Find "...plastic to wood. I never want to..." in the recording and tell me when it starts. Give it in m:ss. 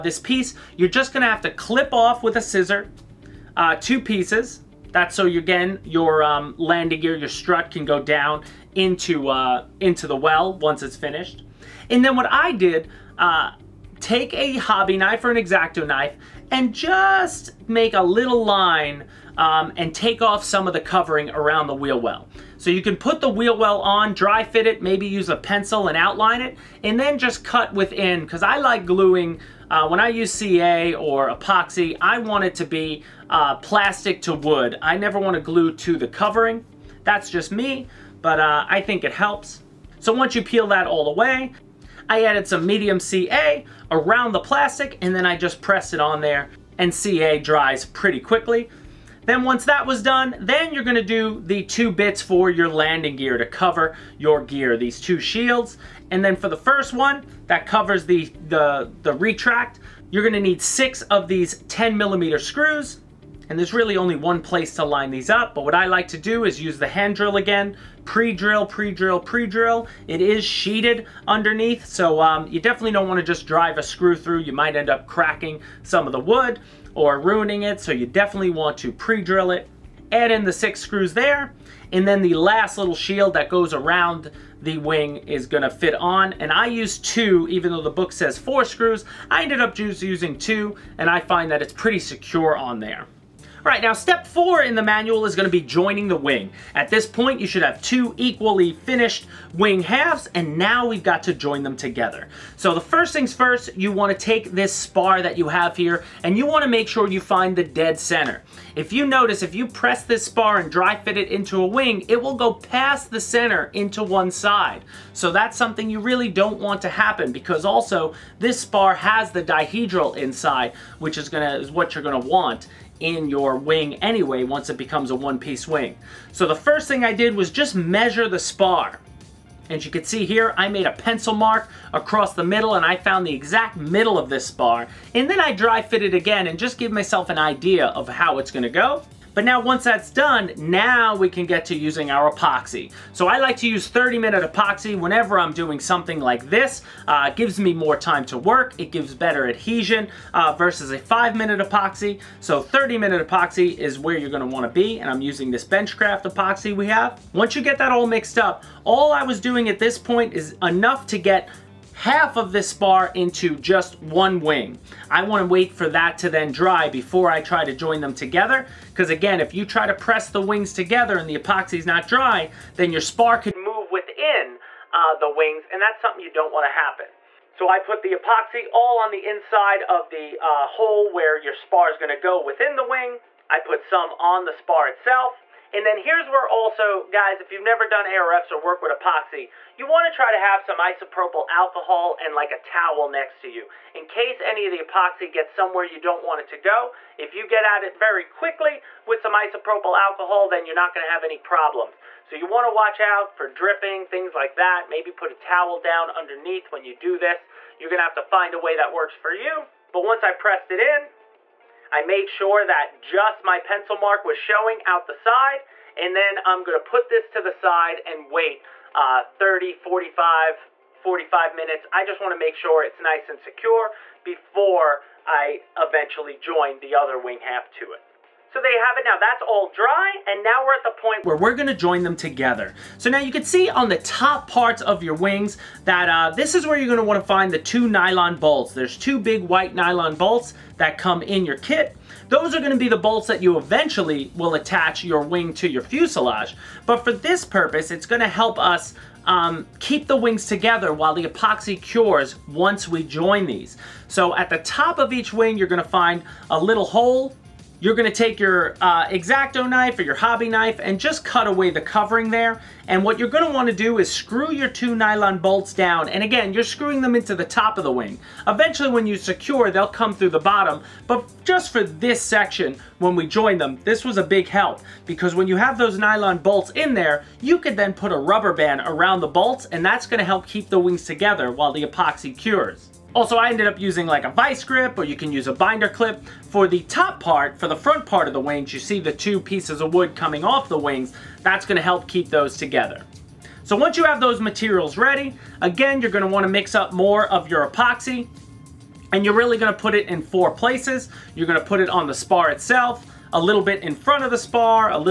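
0:33.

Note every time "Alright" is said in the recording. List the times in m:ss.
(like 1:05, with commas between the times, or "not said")
1:33.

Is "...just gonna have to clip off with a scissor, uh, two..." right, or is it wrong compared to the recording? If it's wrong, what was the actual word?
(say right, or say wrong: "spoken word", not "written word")
right.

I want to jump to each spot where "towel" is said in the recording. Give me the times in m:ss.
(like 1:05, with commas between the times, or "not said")
3:12, 3:25.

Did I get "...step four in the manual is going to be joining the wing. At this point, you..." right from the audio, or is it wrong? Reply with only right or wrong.
right.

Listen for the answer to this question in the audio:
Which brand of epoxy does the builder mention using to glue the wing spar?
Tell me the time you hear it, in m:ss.
2:35.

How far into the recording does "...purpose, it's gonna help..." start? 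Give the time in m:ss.
4:07.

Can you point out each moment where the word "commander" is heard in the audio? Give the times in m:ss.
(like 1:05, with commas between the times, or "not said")
not said.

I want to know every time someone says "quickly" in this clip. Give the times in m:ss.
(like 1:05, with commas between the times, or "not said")
0:48, 3:18.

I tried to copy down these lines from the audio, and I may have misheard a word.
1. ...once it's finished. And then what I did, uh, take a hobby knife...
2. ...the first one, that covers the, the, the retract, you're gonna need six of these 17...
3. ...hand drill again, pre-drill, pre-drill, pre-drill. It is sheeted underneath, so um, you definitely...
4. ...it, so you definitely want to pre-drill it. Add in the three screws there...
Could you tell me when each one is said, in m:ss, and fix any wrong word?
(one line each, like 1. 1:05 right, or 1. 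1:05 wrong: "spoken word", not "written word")
1. 0:10 right
2. 0:56 wrong: "10", not "17"
3. 1:06 right
4. 1:17 wrong: "six", not "three".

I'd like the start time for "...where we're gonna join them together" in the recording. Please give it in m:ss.
3:51.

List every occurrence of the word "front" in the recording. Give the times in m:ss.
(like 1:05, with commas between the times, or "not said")
4:47, 5:03.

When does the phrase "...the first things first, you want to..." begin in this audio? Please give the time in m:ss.
1:42.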